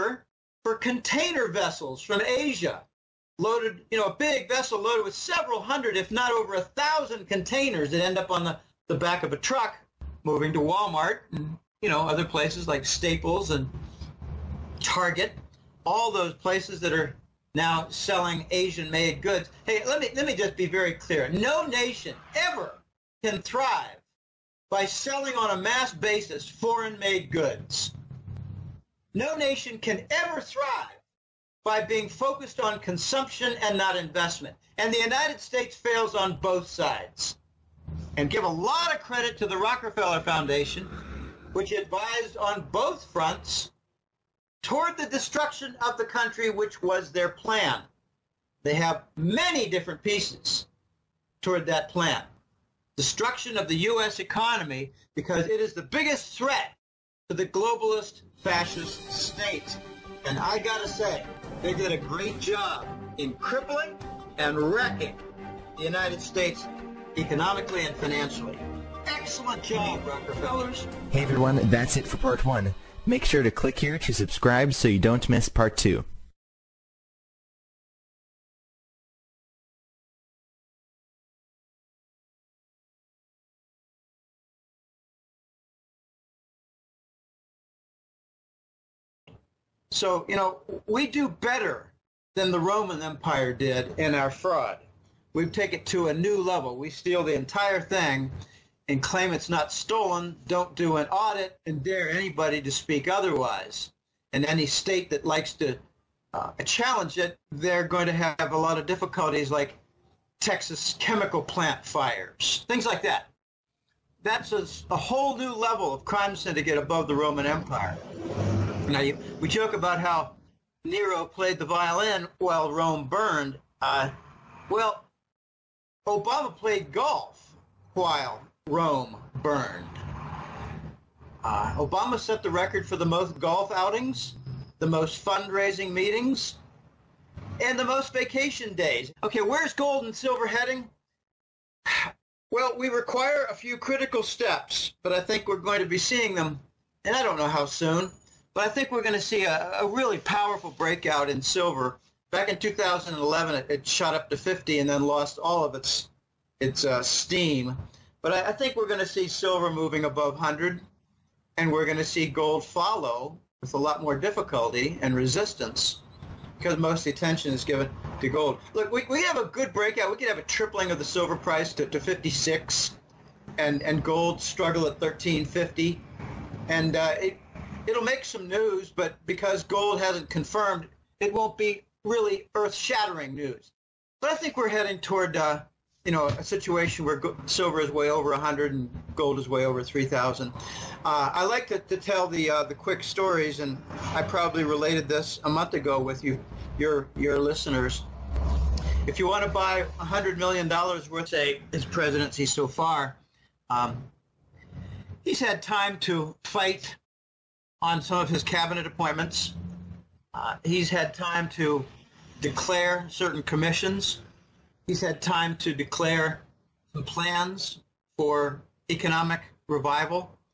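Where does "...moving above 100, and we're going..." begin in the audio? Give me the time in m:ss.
2:39.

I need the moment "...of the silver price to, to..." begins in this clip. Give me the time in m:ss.
2:50.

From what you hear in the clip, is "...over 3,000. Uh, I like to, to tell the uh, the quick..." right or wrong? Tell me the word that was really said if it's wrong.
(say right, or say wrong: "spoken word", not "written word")
right.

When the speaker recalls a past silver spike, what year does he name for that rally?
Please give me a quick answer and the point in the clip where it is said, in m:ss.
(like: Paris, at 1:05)
2011, at 2:32.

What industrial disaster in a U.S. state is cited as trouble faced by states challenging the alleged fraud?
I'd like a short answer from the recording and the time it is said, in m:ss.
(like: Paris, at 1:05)
Texas chemical plant fires, at 1:50.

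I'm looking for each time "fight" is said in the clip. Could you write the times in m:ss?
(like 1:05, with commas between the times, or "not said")
3:26.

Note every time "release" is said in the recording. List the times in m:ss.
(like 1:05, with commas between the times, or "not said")
not said.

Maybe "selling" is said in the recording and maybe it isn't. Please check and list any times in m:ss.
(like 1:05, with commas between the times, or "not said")
0:17, 0:24.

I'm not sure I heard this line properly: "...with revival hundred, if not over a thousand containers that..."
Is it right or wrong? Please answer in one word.
wrong.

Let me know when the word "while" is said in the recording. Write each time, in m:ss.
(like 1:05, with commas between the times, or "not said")
2:02, 2:07.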